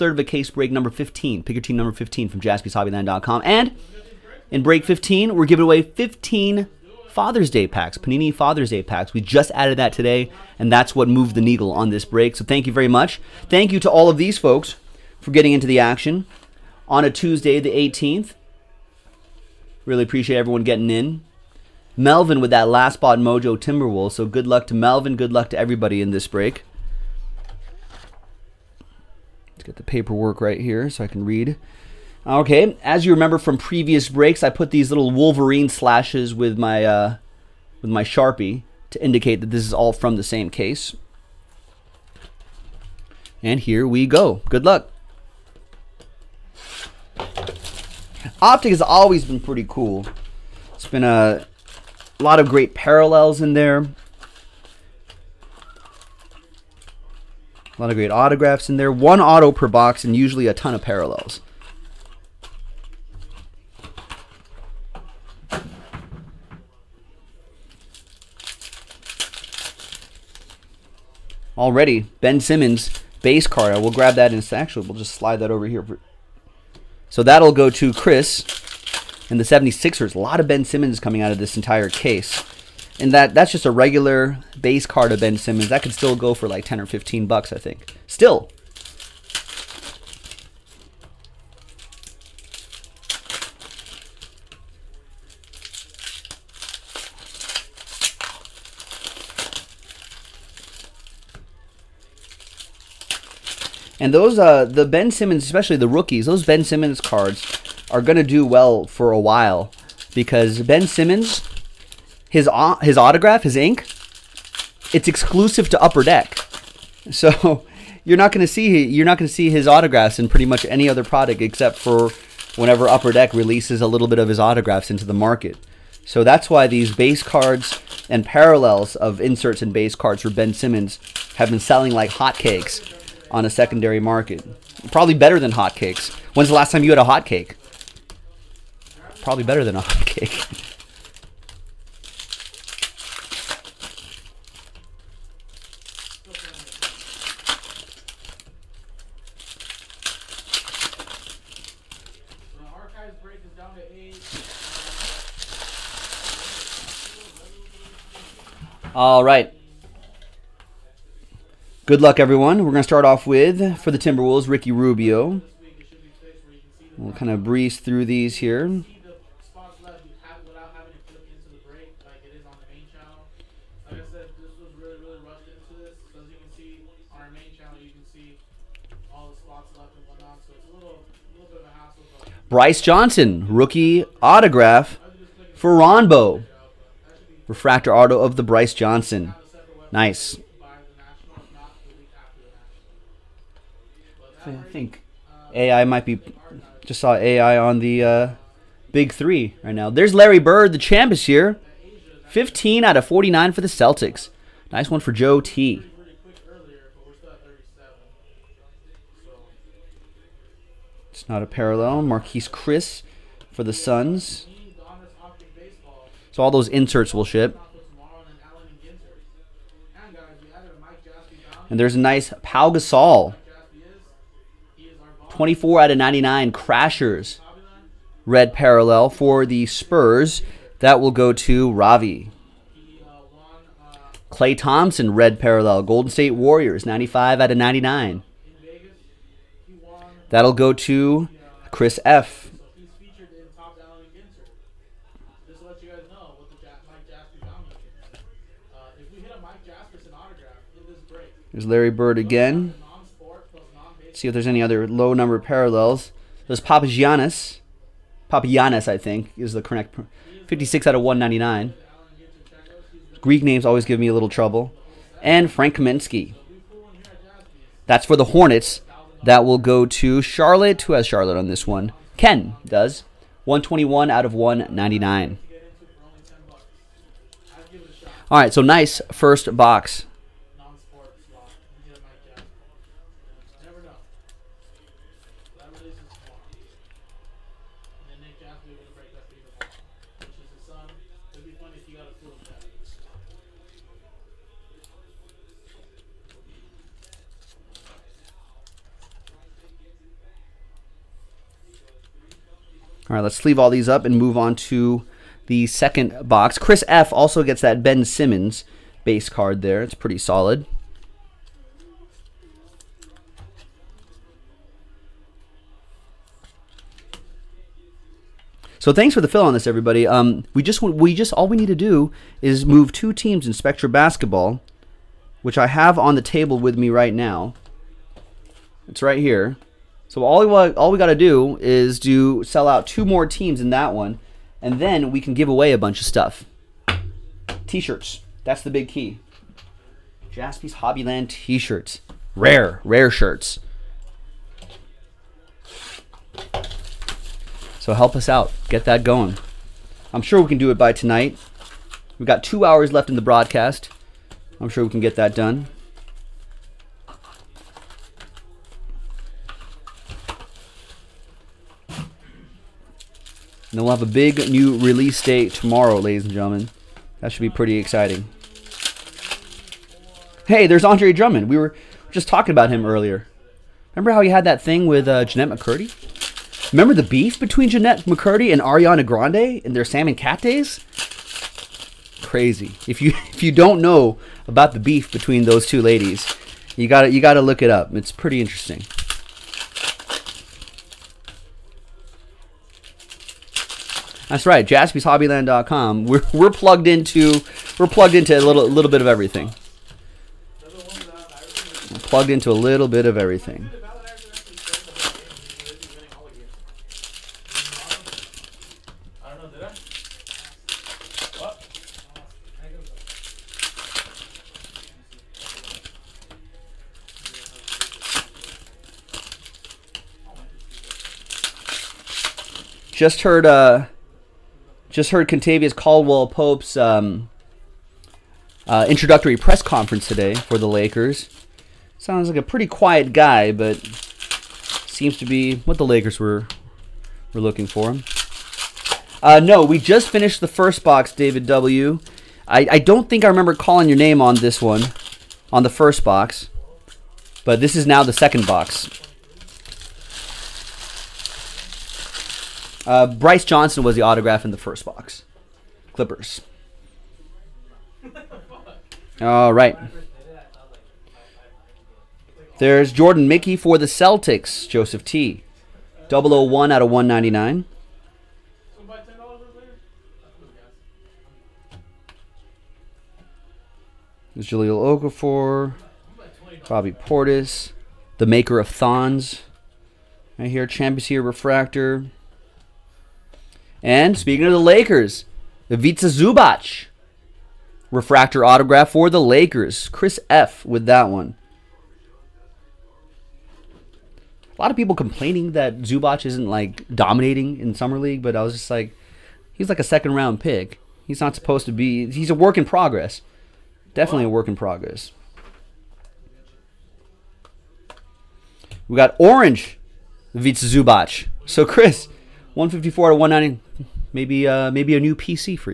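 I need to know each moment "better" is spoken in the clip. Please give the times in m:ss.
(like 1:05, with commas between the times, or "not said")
2:15, 2:19.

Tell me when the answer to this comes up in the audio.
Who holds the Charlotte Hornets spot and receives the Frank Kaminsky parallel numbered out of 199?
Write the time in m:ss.
4:32.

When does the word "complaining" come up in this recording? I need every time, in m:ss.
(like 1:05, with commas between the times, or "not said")
8:14.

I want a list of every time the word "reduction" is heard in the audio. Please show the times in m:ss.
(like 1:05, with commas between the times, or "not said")
not said.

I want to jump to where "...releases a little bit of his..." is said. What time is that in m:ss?
2:03.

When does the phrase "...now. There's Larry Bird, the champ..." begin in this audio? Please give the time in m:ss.
3:19.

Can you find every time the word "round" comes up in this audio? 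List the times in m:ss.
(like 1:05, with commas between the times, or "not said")
8:20.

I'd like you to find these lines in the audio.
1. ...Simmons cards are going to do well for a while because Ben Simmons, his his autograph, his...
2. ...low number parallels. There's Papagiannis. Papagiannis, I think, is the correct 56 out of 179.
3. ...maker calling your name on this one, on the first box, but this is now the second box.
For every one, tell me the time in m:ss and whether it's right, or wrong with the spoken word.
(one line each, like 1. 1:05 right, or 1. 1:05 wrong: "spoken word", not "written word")
1. 1:46 right
2. 4:14 wrong: "199", not "179"
3. 7:23 wrong: "remember", not "maker".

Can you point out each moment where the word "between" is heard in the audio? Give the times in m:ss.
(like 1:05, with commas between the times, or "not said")
6:17, 6:25.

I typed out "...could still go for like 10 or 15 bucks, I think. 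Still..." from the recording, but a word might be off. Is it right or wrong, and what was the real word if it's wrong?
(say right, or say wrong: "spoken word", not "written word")
right.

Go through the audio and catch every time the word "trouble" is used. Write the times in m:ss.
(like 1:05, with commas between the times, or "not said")
4:24.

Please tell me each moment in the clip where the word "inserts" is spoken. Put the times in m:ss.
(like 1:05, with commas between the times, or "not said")
2:09, 3:36.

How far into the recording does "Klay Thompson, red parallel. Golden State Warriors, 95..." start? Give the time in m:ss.
3:54.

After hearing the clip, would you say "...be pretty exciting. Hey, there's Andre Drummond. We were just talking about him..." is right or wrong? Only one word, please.
right.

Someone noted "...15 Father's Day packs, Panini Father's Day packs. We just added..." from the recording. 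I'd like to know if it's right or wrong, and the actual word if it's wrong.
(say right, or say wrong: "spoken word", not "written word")
right.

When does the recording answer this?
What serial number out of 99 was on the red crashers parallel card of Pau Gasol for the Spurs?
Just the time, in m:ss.
3:45.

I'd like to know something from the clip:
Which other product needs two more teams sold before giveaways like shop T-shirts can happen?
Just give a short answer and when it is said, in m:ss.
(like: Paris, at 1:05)
Spectra basketball, at 5:23.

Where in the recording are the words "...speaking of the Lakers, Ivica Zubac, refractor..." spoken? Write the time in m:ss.
8:04.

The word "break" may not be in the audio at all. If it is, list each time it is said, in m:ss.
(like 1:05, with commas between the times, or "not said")
0:00, 0:04, 0:12, 0:26, 0:34.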